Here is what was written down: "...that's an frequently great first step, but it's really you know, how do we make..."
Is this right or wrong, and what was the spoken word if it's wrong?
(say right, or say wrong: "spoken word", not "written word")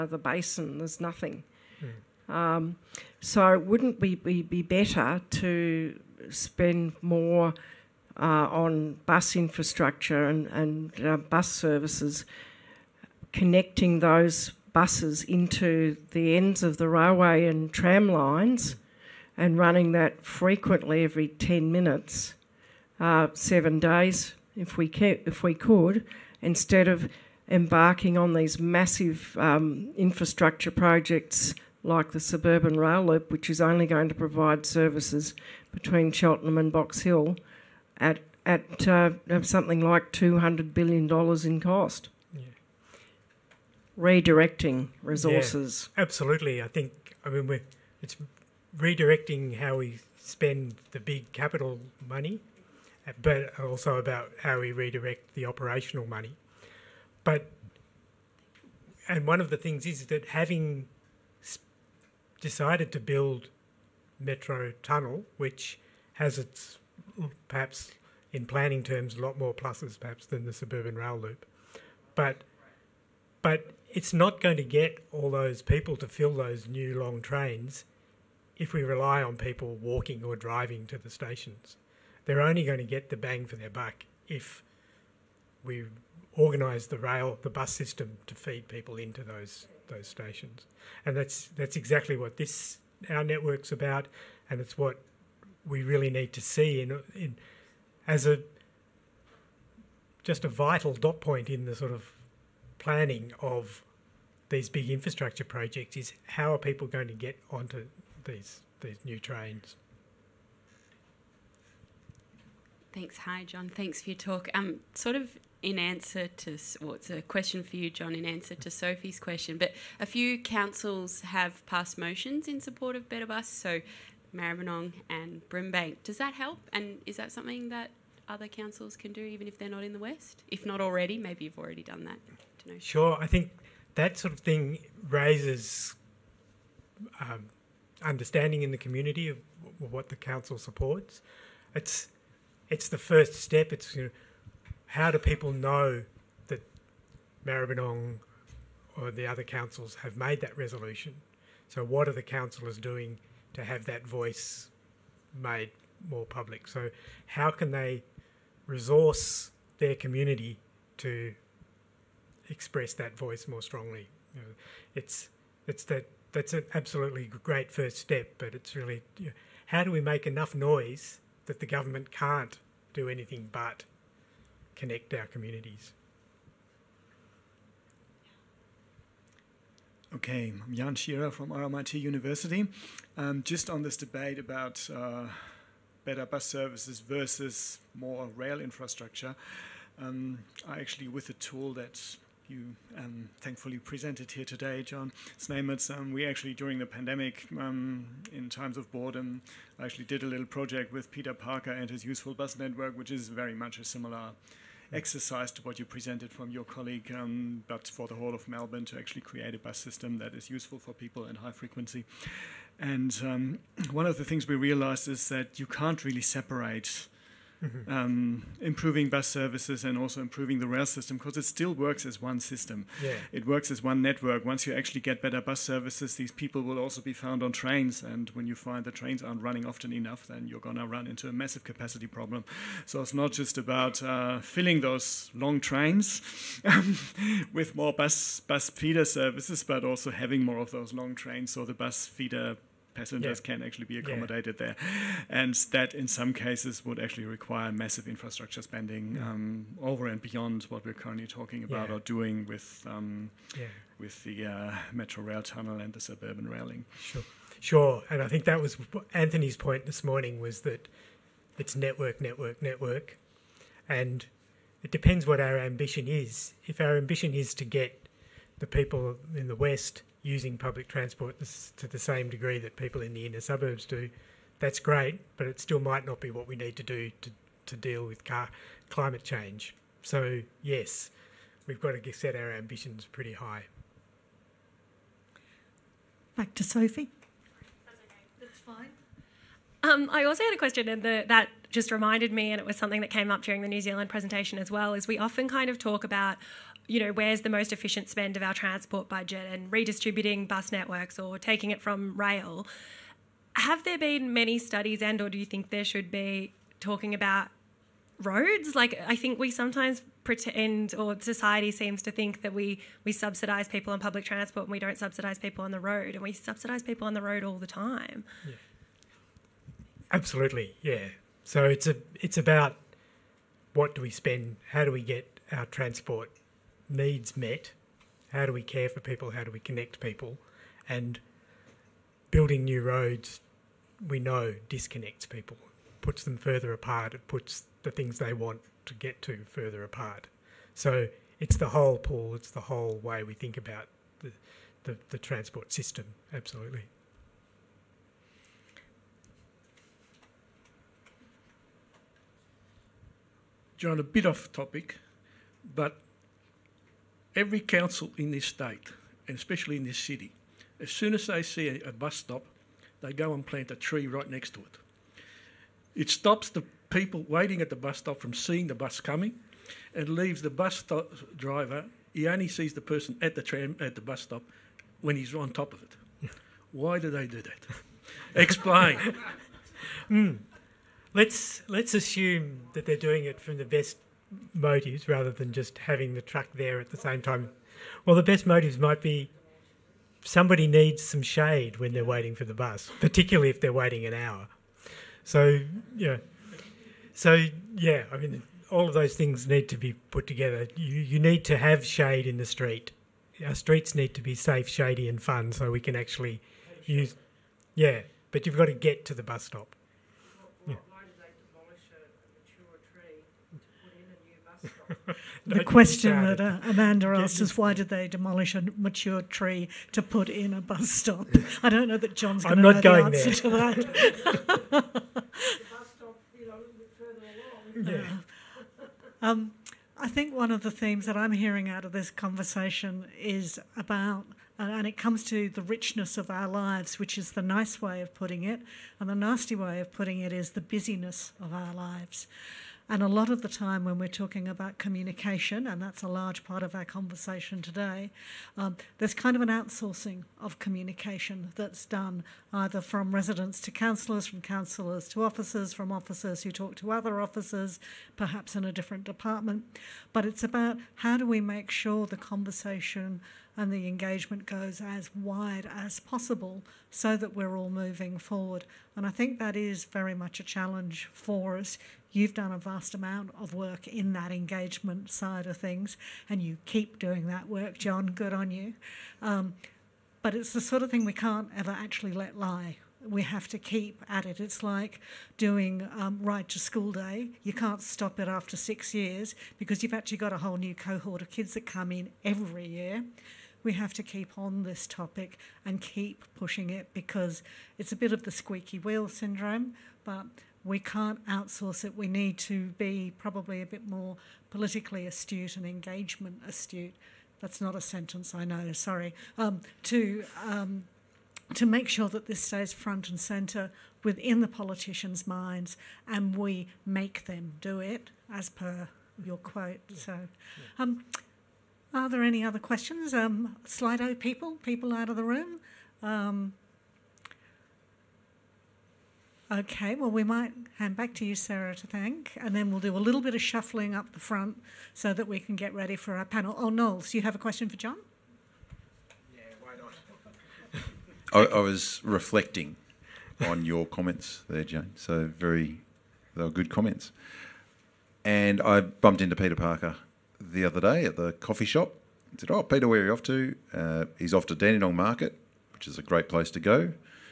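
wrong: "absolutely", not "frequently".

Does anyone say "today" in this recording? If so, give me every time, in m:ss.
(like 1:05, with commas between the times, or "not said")
3:14, 7:27.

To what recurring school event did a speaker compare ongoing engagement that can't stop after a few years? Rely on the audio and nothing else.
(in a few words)
Ride to School Day.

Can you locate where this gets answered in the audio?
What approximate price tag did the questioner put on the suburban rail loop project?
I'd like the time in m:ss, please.
0:40.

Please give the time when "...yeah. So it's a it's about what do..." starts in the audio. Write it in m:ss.
5:20.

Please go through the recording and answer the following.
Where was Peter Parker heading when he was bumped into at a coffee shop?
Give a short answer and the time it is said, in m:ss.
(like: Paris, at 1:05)
Dandenong Market, at 9:14.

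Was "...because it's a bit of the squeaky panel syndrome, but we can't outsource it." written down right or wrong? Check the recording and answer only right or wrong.
wrong.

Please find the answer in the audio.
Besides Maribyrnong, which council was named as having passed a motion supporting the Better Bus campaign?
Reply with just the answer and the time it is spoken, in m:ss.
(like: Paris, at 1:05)
Brimbank, at 2:05.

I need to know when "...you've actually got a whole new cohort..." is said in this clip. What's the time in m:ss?
8:09.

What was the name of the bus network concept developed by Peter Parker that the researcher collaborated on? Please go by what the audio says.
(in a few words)
Useful Bus Network.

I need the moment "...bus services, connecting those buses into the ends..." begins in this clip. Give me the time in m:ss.
0:11.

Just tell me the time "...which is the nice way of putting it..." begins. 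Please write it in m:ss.
7:16.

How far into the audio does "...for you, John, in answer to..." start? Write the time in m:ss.
1:57.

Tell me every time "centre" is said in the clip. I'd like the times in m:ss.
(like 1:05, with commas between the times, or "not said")
8:33.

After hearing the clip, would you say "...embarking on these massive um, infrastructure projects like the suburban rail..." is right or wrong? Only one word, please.
right.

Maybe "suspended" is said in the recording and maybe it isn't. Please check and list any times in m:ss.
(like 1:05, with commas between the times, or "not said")
not said.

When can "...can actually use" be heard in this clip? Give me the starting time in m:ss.
6:45.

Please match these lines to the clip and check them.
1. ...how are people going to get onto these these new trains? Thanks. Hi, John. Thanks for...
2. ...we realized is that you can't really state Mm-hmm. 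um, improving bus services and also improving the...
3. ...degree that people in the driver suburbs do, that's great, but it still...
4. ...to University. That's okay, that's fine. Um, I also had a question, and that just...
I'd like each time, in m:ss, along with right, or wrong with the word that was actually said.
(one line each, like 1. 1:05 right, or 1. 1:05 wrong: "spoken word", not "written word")
1. 1:46 right
2. 3:34 wrong: "separate", not "state"
3. 4:32 wrong: "inner", not "driver"
4. 4:46 wrong: "Sophie", not "University".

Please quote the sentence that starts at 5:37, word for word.
It puts the things they want to get to further apart.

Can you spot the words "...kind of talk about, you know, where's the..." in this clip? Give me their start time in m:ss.
4:55.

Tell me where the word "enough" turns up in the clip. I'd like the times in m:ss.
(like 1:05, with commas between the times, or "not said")
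2:50, 3:49.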